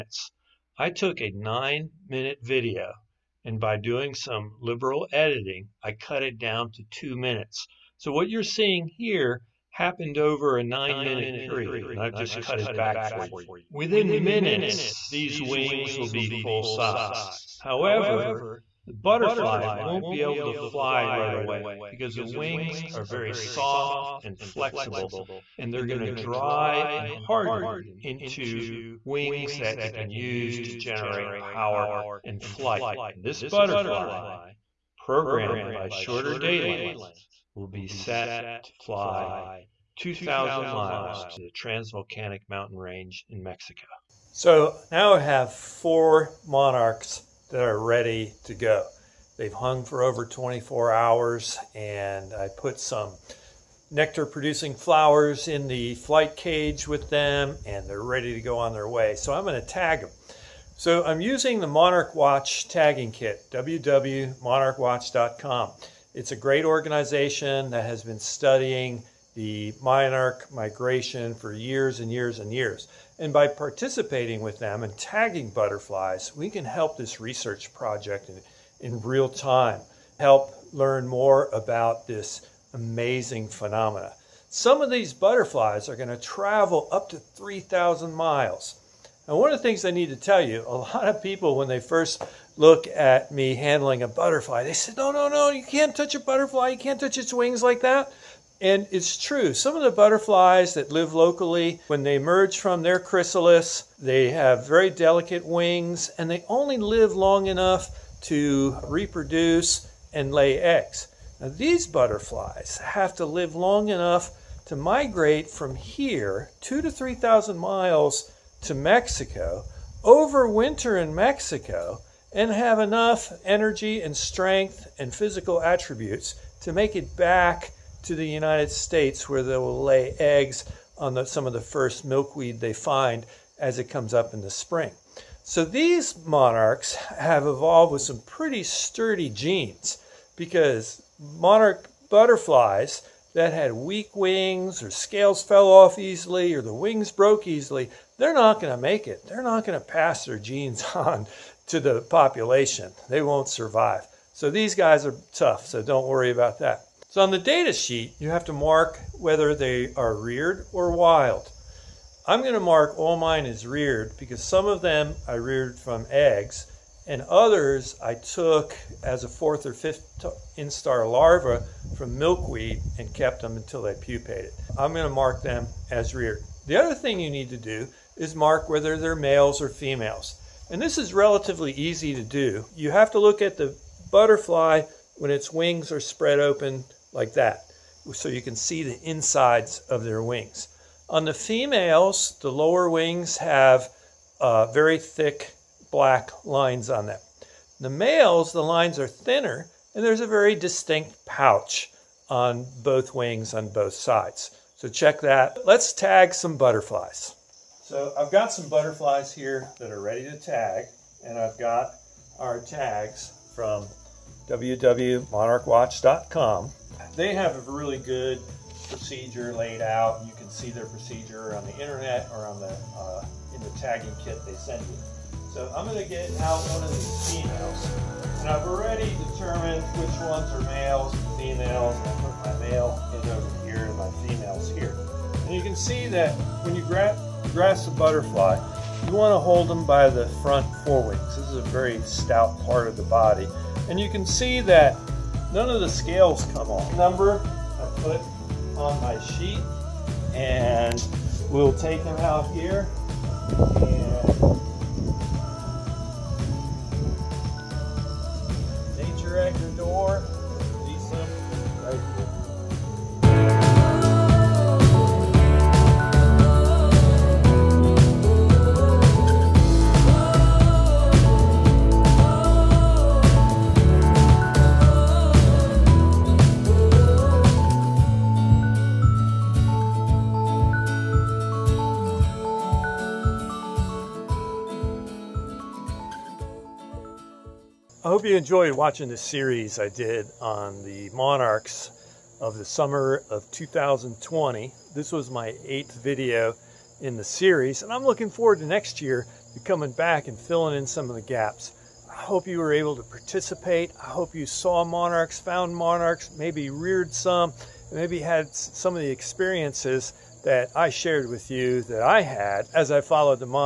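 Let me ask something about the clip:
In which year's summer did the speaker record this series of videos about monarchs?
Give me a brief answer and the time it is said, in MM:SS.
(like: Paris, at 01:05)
2020, at 04:53.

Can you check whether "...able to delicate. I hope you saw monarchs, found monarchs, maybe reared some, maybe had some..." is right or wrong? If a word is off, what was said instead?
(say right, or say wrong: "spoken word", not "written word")
wrong: "participate", not "delicate".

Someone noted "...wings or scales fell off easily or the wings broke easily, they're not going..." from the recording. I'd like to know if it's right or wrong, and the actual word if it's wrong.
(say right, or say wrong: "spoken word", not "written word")
right.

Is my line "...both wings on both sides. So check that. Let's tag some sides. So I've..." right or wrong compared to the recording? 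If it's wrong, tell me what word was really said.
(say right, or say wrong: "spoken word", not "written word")
wrong: "butterflies", not "sides".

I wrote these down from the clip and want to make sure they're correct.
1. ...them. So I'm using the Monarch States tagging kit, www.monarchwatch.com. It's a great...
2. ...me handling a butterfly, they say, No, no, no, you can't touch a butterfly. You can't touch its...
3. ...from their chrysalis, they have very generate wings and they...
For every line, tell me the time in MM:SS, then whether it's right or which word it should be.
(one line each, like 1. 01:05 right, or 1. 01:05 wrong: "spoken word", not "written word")
1. 01:00 wrong: "Watch", not "States"
2. 01:33 right
3. 01:42 wrong: "delicate", not "generate".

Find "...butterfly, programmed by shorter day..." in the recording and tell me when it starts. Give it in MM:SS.
00:33.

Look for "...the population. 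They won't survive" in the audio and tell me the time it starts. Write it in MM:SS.
02:31.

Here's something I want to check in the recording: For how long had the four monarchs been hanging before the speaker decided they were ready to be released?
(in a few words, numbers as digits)
Over 24 hours.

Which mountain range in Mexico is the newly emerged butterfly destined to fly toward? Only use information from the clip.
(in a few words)
Transvolcanic Mountain Range.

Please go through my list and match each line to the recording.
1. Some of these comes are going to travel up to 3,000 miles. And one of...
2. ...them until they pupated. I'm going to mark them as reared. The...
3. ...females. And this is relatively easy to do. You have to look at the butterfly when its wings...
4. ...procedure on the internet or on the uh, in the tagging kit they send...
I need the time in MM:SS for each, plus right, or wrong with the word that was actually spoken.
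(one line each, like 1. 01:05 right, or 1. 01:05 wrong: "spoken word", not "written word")
1. 01:24 wrong: "butterflies", not "comes"
2. 02:53 right
3. 02:59 right
4. 03:40 right.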